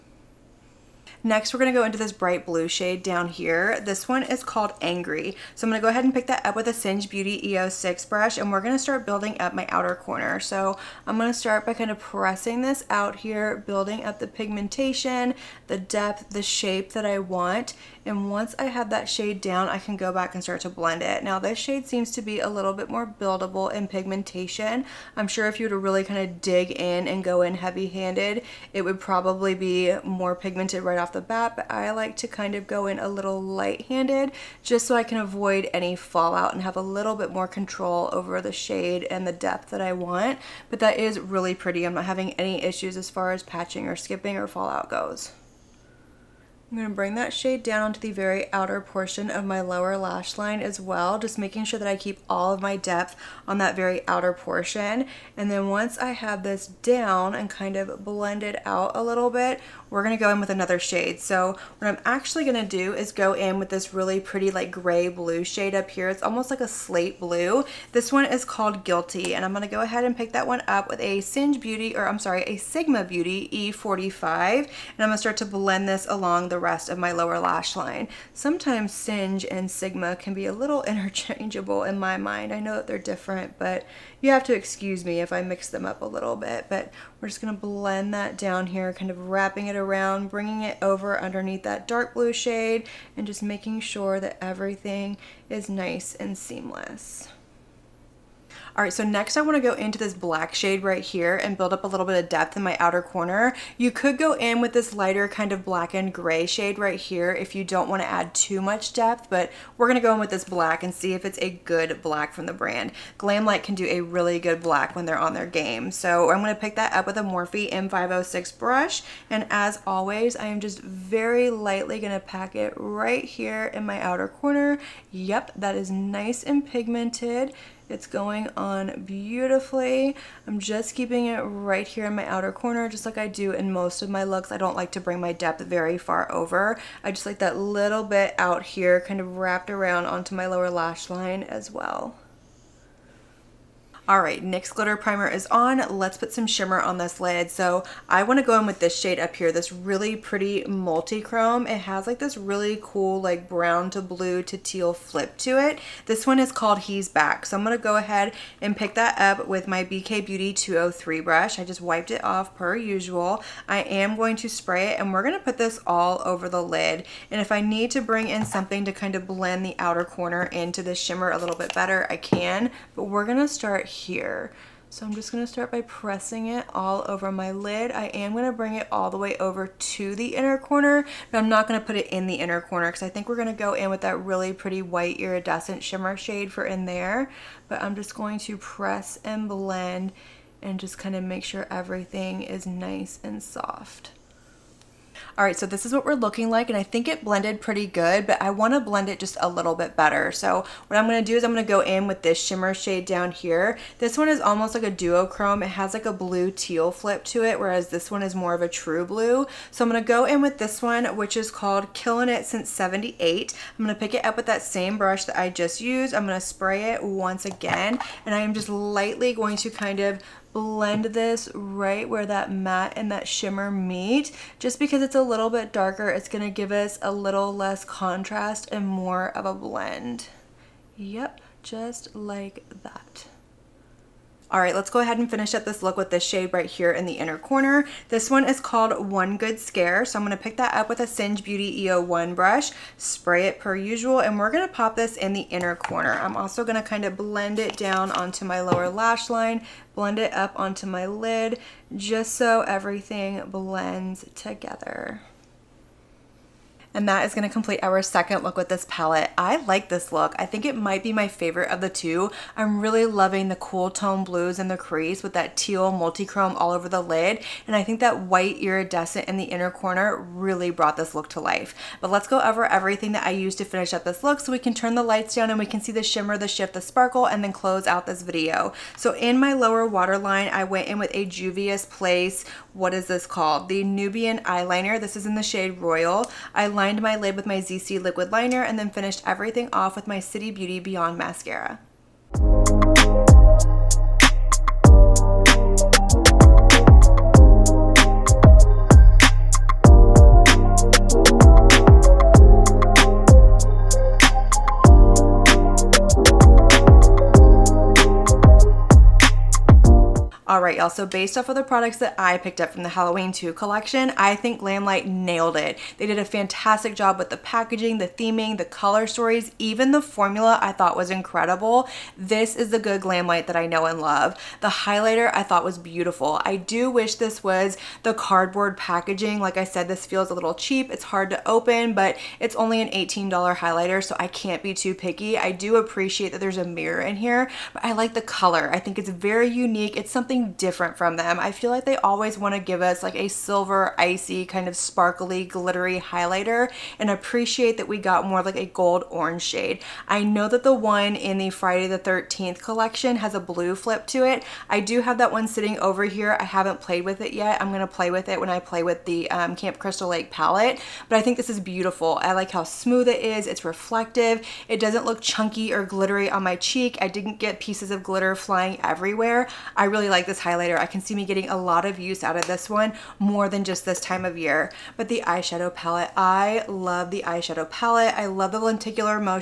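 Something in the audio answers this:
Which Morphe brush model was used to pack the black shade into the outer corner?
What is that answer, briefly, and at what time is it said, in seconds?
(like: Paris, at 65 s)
M506, at 117 s.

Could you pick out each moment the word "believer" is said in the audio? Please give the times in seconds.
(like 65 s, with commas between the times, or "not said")
not said.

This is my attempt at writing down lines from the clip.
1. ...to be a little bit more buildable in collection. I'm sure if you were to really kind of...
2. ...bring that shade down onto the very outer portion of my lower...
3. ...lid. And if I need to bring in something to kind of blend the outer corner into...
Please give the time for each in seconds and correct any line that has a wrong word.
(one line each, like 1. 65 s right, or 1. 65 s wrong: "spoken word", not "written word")
1. 22 s wrong: "pigmentation", not "collection"
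2. 46 s right
3. 166 s right.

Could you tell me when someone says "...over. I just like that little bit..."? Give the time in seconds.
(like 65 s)
136 s.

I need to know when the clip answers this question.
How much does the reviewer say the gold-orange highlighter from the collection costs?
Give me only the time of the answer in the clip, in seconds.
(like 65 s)
332 s.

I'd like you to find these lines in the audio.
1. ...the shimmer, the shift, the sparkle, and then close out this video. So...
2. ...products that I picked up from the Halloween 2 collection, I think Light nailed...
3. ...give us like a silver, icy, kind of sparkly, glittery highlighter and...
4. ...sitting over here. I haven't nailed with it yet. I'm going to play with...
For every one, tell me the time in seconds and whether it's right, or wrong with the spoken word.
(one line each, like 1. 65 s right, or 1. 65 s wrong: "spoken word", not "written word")
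1. 275 s right
2. 311 s right
3. 342 s right
4. 355 s wrong: "played", not "nailed".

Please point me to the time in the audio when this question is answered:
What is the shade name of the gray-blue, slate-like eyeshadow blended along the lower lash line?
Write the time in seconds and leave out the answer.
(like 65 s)
68 s.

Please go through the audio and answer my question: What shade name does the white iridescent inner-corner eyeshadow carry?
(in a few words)
One Good Scare.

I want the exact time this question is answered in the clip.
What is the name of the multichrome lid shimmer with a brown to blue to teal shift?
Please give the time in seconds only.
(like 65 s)
156 s.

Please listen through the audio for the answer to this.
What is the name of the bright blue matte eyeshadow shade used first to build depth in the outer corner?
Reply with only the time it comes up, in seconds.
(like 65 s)
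4 s.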